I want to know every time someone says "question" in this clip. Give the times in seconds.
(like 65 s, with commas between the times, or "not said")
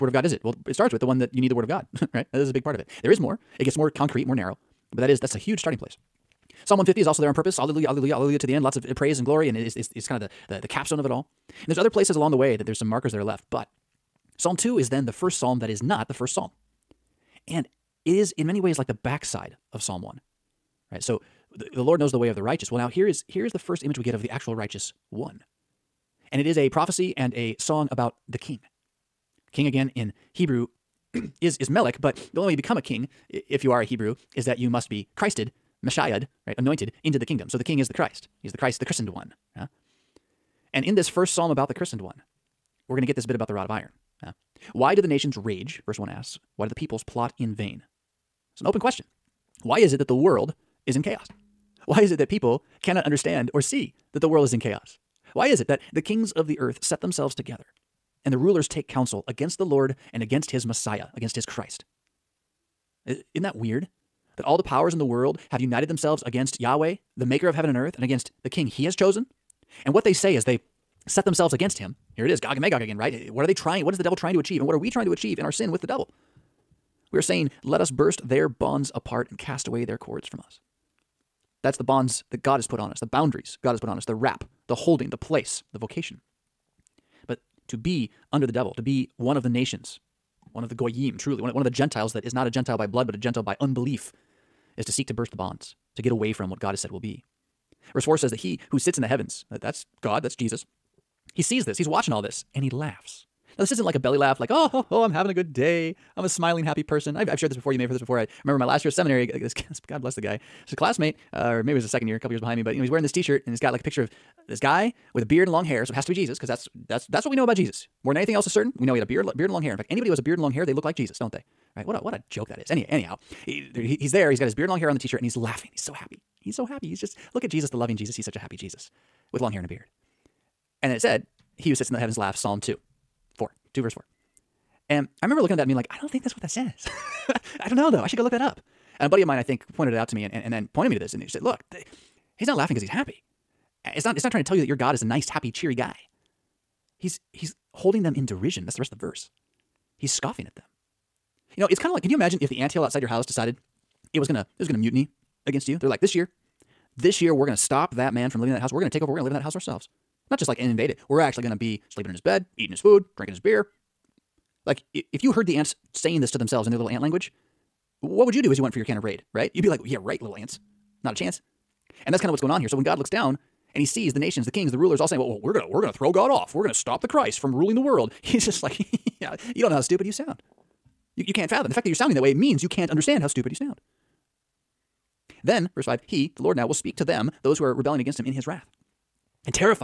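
48 s.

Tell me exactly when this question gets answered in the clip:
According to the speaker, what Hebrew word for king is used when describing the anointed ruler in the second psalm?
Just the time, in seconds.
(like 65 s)
31 s.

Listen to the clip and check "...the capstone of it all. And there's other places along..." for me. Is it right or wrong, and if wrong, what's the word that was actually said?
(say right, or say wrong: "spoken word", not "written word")
right.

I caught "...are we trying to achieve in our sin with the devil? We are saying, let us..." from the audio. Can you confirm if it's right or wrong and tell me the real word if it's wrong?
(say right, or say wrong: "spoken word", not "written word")
right.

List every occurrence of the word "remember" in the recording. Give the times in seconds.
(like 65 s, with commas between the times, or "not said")
108 s, 135 s.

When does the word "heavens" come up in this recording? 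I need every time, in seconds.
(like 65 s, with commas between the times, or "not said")
67 s, 99 s, 131 s.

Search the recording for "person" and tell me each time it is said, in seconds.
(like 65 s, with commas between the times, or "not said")
106 s.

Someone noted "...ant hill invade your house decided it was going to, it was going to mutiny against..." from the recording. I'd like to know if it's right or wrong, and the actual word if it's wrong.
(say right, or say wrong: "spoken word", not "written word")
wrong: "outside", not "invade".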